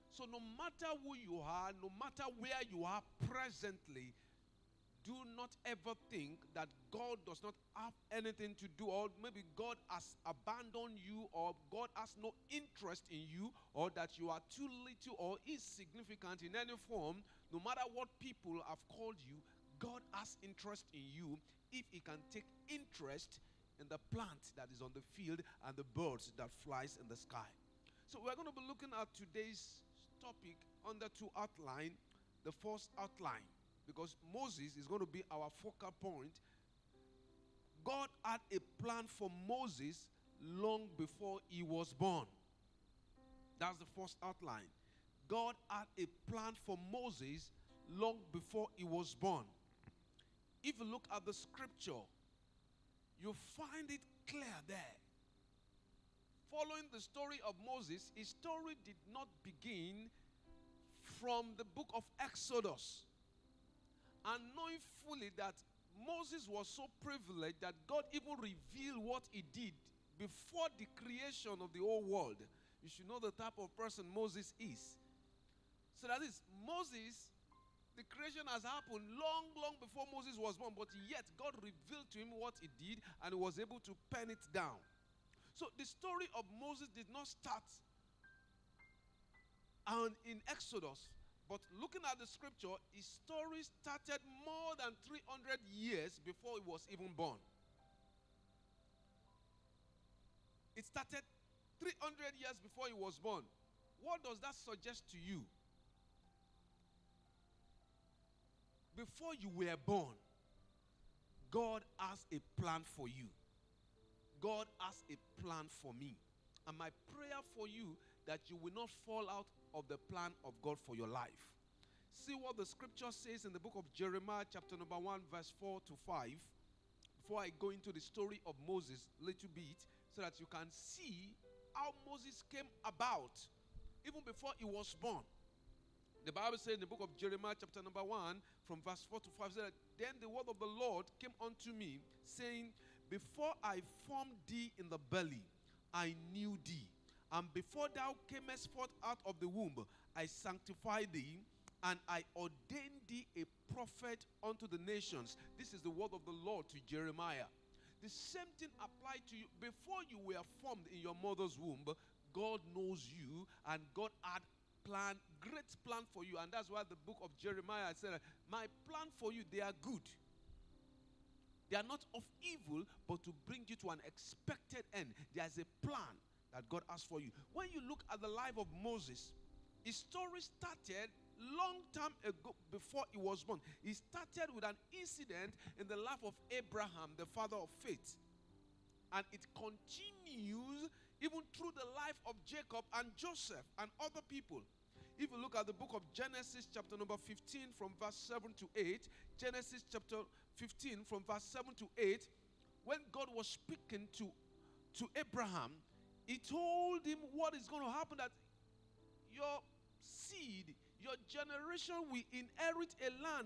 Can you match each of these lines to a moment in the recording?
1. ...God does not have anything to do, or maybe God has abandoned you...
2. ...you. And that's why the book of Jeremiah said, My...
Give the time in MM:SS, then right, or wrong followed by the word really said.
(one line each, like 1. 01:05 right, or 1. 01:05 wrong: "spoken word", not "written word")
1. 00:06 right
2. 02:46 right.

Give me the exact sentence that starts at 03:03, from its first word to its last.
He started with an incident in the life of Abraham, the father of faith.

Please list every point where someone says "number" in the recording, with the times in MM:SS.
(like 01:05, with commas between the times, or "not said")
02:04, 02:17, 03:16.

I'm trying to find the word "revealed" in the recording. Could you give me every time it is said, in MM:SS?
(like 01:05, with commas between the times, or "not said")
01:08, 01:21.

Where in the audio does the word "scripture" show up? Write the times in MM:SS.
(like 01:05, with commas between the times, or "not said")
00:51, 01:32, 02:02.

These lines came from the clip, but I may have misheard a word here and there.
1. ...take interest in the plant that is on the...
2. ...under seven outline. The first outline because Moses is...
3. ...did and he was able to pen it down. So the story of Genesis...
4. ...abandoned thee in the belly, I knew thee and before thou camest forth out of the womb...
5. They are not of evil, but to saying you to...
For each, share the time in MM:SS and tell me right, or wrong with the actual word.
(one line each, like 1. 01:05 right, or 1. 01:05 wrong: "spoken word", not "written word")
1. 00:22 right
2. 00:30 wrong: "two", not "seven"
3. 01:22 wrong: "Moses", not "Genesis"
4. 02:24 wrong: "formed", not "abandoned"
5. 02:51 wrong: "bring", not "saying".